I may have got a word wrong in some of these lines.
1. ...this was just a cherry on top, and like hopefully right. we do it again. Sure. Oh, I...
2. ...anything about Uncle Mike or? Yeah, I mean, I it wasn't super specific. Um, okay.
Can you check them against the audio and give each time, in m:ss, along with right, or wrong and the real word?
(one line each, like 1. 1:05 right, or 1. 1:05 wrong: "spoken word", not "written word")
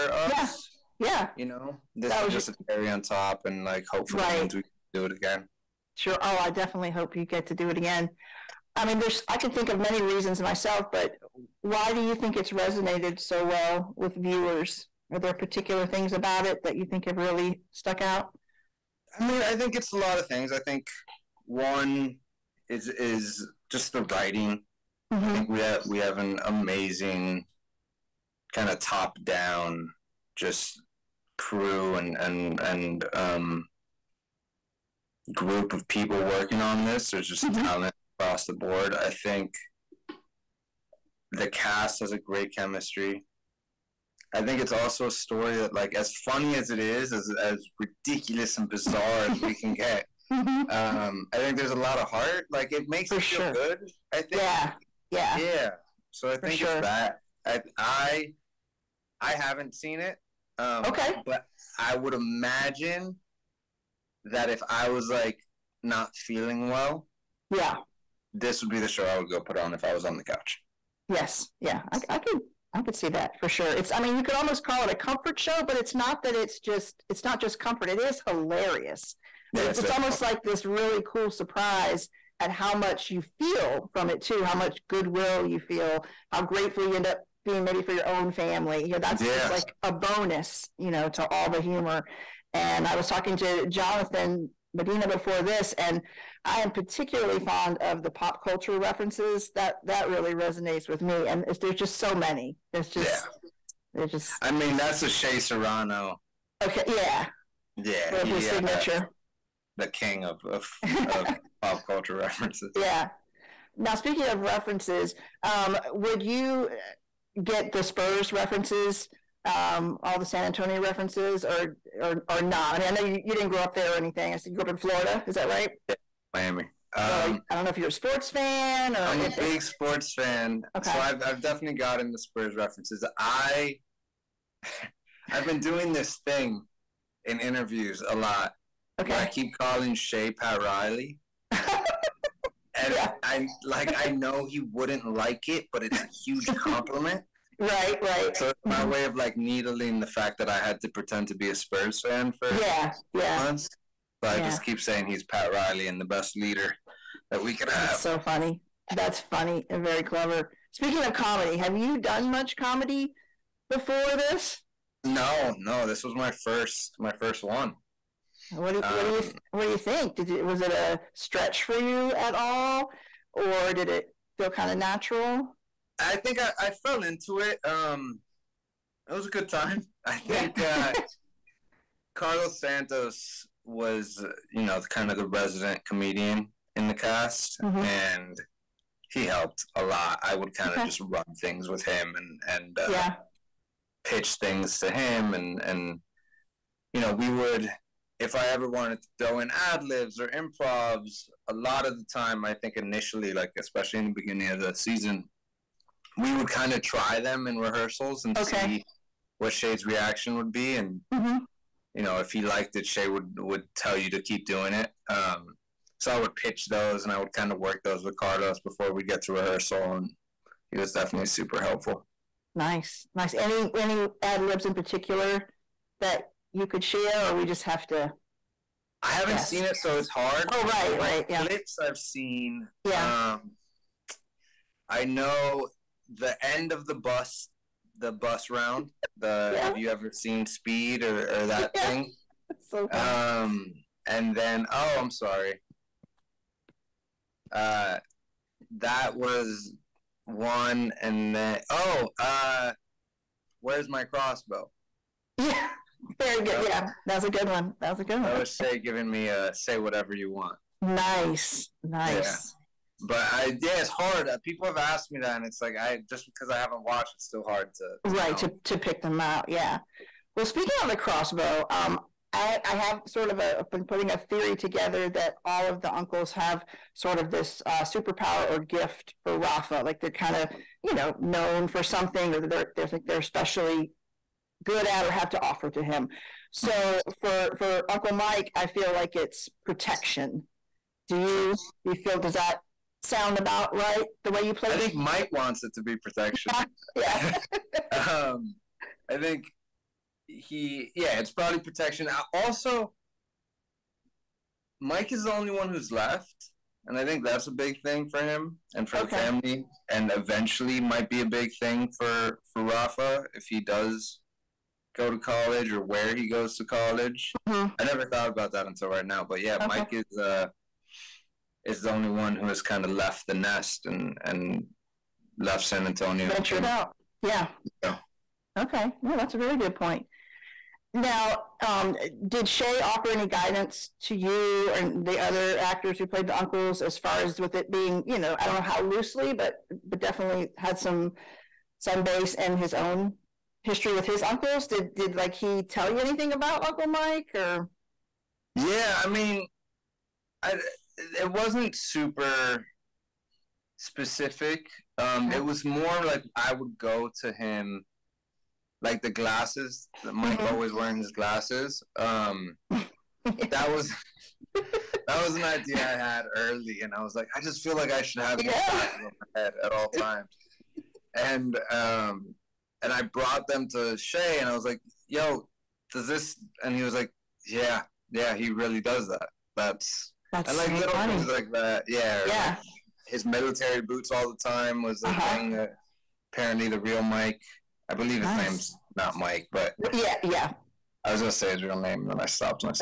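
1. 0:01 right
2. 5:46 right.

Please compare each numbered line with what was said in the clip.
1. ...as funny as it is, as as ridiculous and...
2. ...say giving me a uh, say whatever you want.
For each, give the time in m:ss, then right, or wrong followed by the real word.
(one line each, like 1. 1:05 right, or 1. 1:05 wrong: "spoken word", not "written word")
1. 0:45 right
2. 4:18 right.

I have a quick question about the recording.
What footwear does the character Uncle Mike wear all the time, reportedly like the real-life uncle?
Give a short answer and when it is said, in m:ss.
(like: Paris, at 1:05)
military boots, at 6:23.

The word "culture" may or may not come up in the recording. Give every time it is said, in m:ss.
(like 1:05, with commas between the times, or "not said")
1:38, 1:51.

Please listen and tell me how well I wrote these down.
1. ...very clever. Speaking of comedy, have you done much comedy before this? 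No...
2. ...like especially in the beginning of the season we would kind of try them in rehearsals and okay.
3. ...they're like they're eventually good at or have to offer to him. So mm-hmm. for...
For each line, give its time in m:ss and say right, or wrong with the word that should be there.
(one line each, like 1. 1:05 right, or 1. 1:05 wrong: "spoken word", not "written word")
1. 2:39 right
2. 3:23 right
3. 4:42 wrong: "especially", not "eventually".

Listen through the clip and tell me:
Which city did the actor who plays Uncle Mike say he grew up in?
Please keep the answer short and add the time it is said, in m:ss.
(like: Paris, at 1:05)
Miami, at 2:06.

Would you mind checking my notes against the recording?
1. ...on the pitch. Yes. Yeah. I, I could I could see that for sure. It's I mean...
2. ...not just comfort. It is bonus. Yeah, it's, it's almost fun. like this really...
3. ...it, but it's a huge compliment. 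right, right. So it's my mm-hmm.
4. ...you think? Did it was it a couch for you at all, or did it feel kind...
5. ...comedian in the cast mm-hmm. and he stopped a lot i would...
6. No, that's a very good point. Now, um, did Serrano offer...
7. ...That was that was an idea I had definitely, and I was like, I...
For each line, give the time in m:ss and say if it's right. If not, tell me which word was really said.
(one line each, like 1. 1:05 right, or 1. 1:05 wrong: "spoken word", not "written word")
1. 1:10 wrong: "couch", not "pitch"
2. 1:17 wrong: "hilarious", not "bonus"
3. 2:25 right
4. 2:49 wrong: "stretch", not "couch"
5. 3:05 wrong: "helped", not "stopped"
6. 5:29 wrong: "Shea", not "Serrano"
7. 6:03 wrong: "early", not "definitely".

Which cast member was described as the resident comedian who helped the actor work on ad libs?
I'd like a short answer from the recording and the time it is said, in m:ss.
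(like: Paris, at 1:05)
Carlos Santos, at 3:02.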